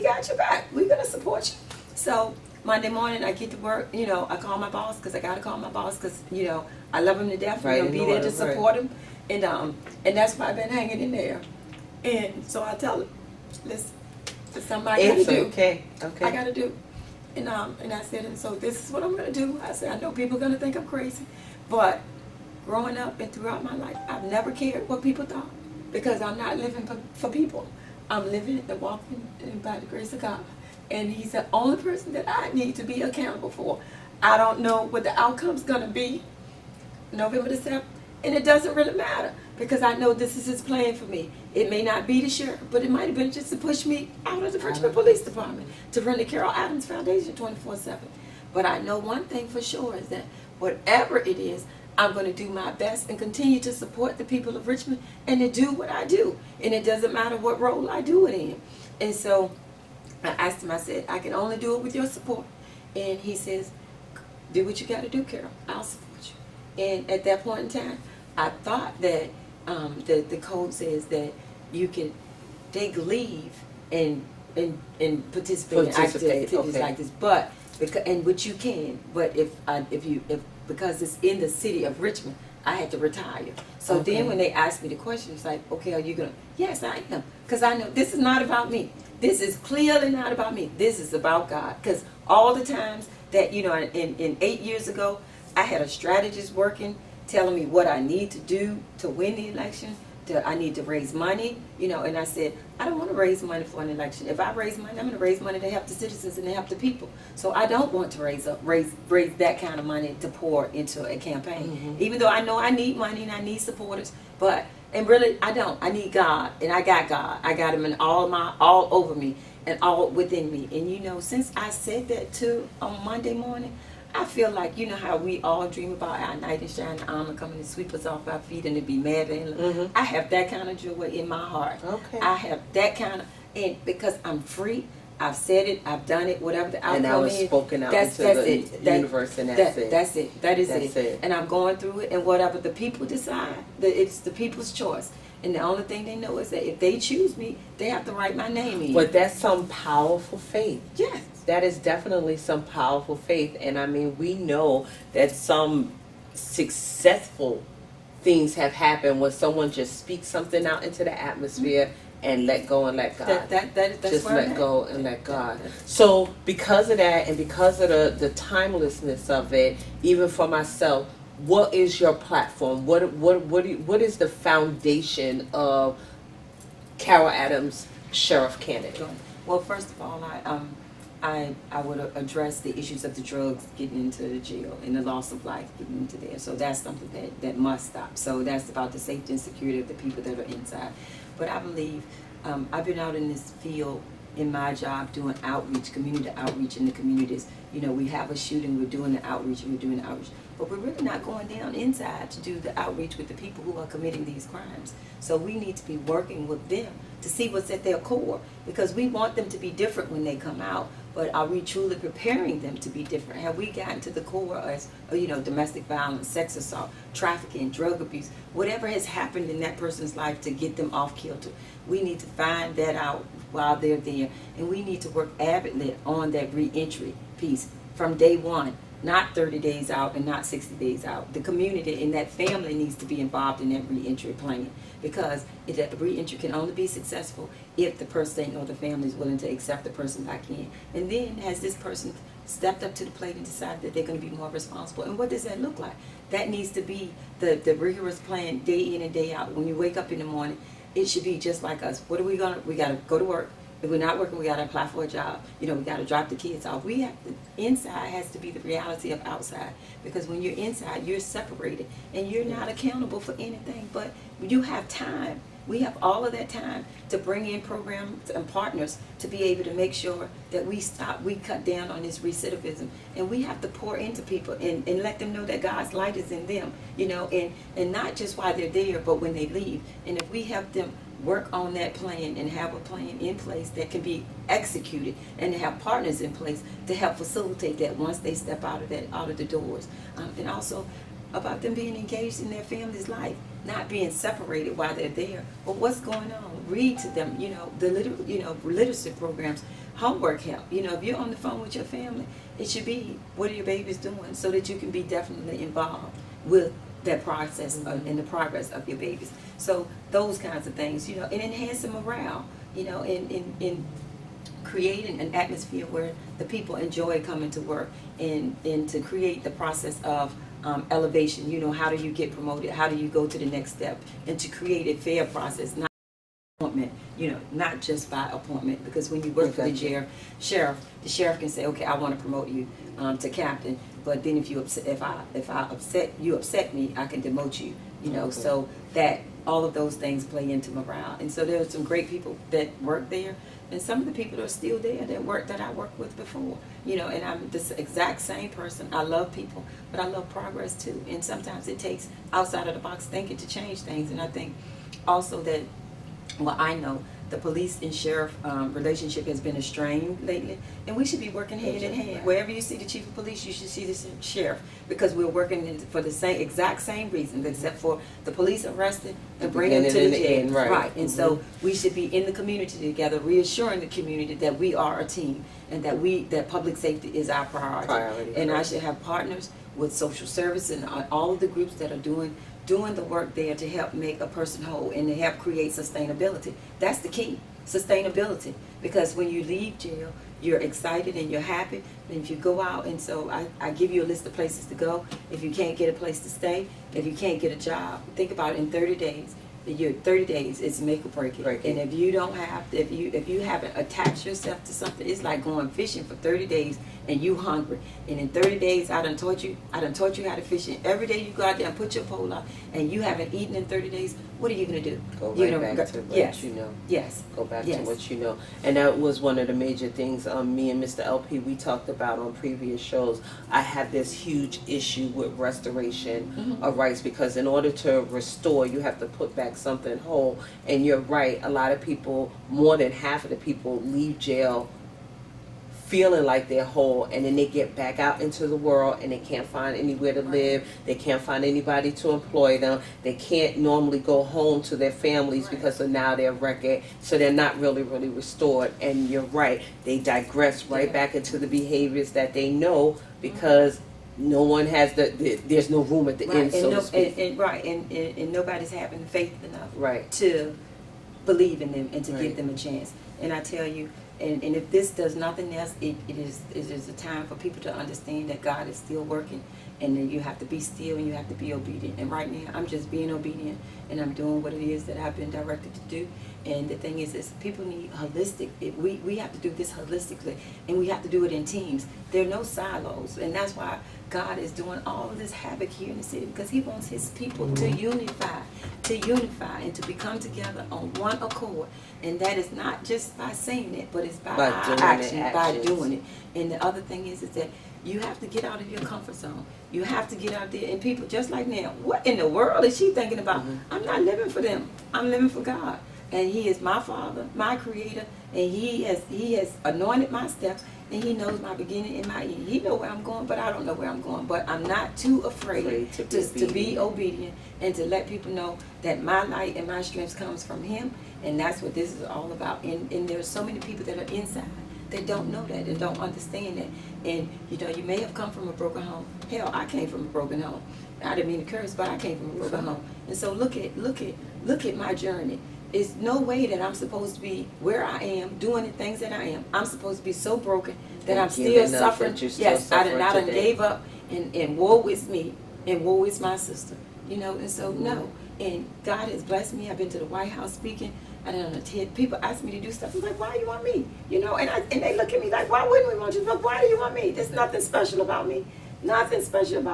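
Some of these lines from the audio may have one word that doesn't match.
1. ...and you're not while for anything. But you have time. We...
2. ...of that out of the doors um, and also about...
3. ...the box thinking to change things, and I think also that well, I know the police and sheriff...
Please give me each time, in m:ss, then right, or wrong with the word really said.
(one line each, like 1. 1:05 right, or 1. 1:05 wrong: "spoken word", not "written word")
1. 4:22 wrong: "accountable", not "while"
2. 4:48 right
3. 5:52 right.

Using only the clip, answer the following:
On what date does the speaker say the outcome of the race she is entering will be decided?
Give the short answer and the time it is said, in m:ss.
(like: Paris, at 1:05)
November 7, at 0:37.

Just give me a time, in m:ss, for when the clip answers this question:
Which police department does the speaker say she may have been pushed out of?
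0:44.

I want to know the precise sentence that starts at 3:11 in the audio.
But I believe um, I've been out in this field in my job doing outreach, community outreach in the communities.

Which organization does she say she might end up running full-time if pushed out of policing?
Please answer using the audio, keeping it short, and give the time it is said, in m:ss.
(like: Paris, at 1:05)
Carol Adams Foundation, at 0:46.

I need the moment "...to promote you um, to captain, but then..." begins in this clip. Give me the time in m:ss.
5:32.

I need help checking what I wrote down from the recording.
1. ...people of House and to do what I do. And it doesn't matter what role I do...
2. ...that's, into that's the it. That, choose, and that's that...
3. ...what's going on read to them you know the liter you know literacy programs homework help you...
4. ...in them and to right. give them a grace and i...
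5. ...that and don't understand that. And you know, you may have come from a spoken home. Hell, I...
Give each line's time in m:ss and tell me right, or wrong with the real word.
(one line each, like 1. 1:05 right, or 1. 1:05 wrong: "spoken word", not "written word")
1. 0:54 wrong: "Richmond", not "House"
2. 2:17 wrong: "universe", not "choose"
3. 4:55 right
4. 7:41 wrong: "chance", not "grace"
5. 8:45 wrong: "broken", not "spoken".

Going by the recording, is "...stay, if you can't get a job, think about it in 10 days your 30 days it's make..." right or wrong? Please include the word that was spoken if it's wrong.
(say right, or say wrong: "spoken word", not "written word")
wrong: "30", not "10".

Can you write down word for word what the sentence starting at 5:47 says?
And I'm this exact same person.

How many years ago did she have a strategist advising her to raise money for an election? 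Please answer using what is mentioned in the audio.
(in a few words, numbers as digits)
8.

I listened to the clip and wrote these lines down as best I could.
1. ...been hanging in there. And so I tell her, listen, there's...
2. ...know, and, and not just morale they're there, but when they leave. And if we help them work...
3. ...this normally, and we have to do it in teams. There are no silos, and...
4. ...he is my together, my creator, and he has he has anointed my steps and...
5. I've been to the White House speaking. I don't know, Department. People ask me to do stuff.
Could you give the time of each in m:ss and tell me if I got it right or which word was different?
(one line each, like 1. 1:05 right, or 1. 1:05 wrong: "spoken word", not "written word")
1. 0:10 right
2. 4:37 wrong: "while", not "morale"
3. 7:59 wrong: "holistically", not "normally"
4. 8:26 wrong: "father", not "together"
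5. 9:09 wrong: "TED", not "Department".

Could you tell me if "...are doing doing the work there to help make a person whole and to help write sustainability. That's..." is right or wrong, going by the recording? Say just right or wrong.
wrong.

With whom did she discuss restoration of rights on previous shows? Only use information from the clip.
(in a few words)
Mr. LP.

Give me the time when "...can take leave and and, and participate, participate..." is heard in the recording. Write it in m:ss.
1:11.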